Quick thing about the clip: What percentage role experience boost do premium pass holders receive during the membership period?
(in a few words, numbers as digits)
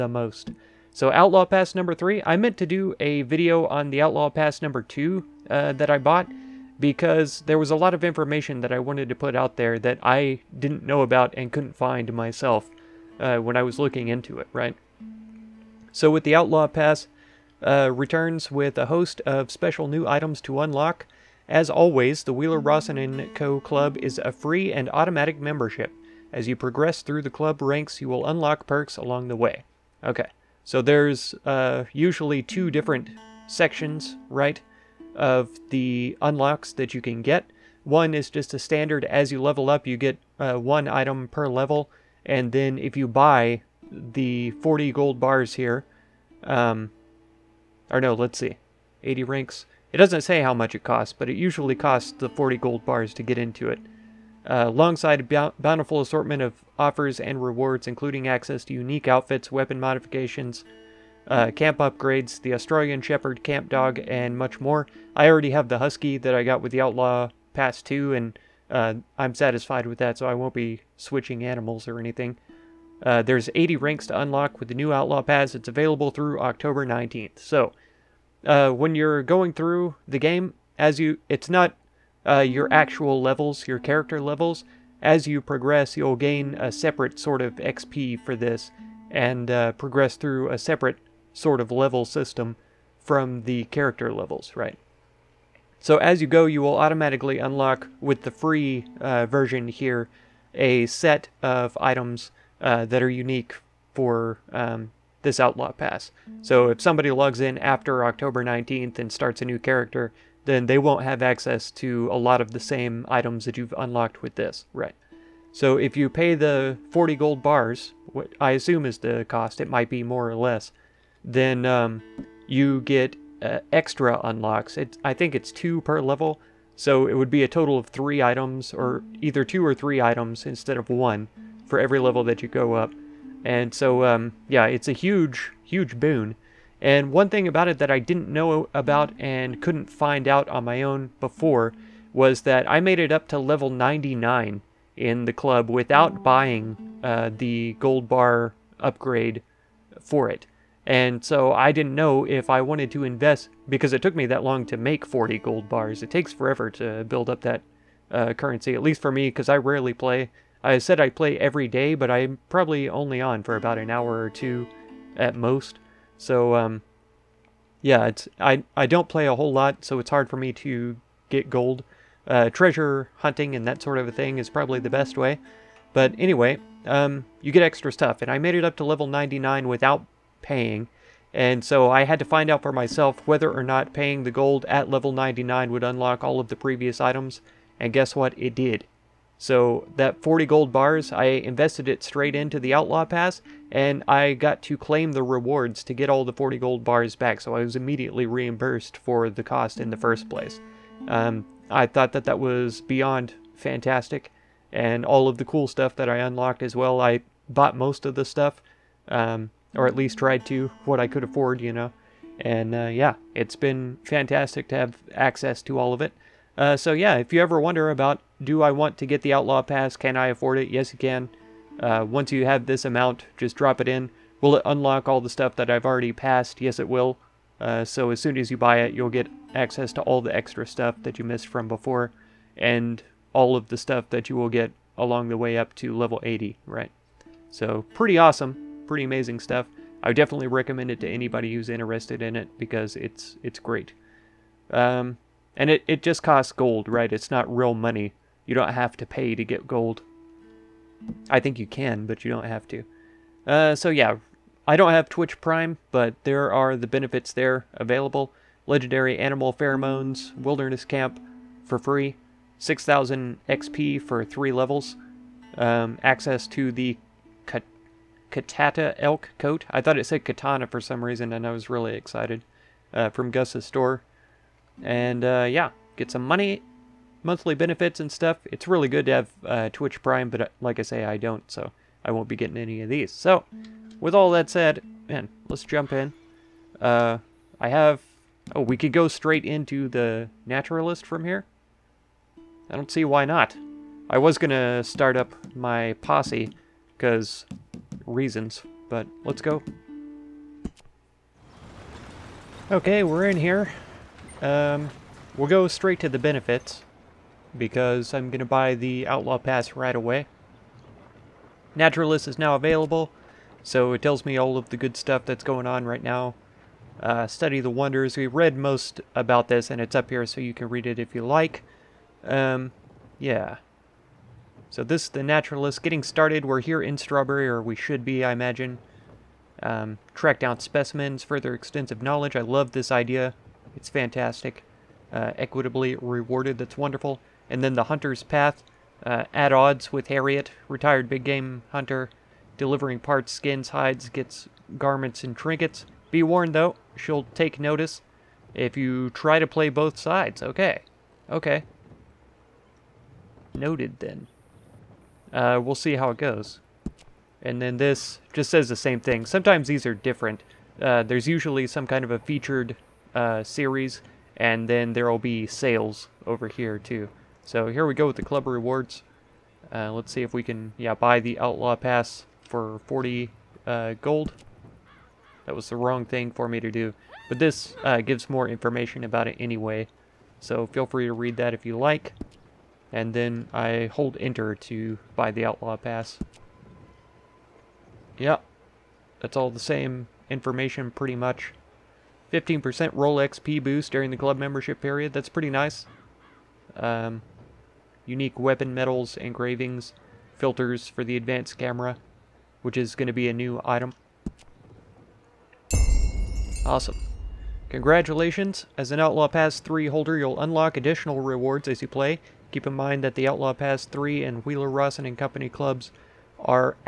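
15%.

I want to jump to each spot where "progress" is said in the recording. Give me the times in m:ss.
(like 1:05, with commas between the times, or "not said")
0:26, 1:25, 1:29.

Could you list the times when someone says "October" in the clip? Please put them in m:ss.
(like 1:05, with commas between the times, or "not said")
1:16, 1:48.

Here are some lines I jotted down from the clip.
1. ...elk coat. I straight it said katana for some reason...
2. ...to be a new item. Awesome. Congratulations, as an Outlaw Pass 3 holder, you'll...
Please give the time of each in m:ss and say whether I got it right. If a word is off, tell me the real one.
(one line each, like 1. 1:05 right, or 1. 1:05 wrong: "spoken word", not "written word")
1. 4:28 wrong: "thought", not "straight"
2. 6:43 right.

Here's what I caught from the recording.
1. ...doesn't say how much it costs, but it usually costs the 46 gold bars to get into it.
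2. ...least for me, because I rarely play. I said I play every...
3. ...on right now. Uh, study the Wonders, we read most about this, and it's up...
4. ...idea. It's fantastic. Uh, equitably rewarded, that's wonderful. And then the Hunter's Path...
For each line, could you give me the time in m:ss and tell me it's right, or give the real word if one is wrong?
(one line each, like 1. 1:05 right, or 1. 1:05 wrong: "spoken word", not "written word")
1. 0:49 wrong: "40", not "46"
2. 2:38 right
3. 5:15 right
4. 5:32 right.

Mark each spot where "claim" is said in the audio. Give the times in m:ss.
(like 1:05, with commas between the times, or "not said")
3:14.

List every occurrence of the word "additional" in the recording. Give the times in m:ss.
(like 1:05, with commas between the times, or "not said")
6:50.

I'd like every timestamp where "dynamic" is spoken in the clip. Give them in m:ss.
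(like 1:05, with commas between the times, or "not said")
not said.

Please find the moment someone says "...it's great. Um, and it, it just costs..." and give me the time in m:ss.
4:03.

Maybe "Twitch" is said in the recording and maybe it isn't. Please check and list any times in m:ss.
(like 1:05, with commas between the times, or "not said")
4:15, 4:39.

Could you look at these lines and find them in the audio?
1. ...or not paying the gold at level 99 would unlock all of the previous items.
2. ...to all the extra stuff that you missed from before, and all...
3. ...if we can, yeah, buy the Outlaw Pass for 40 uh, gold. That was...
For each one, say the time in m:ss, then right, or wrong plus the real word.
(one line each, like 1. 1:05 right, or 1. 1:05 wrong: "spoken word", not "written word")
1. 3:03 right
2. 3:49 right
3. 6:10 right.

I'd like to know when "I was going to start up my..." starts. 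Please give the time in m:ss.
4:54.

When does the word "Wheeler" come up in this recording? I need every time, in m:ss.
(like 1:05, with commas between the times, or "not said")
0:22, 6:54.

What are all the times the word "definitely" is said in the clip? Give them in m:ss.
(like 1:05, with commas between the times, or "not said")
4:00.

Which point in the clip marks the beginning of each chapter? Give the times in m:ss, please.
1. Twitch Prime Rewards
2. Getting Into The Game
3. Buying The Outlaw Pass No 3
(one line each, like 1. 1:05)
1. 4:12
2. 4:45
3. 6:06.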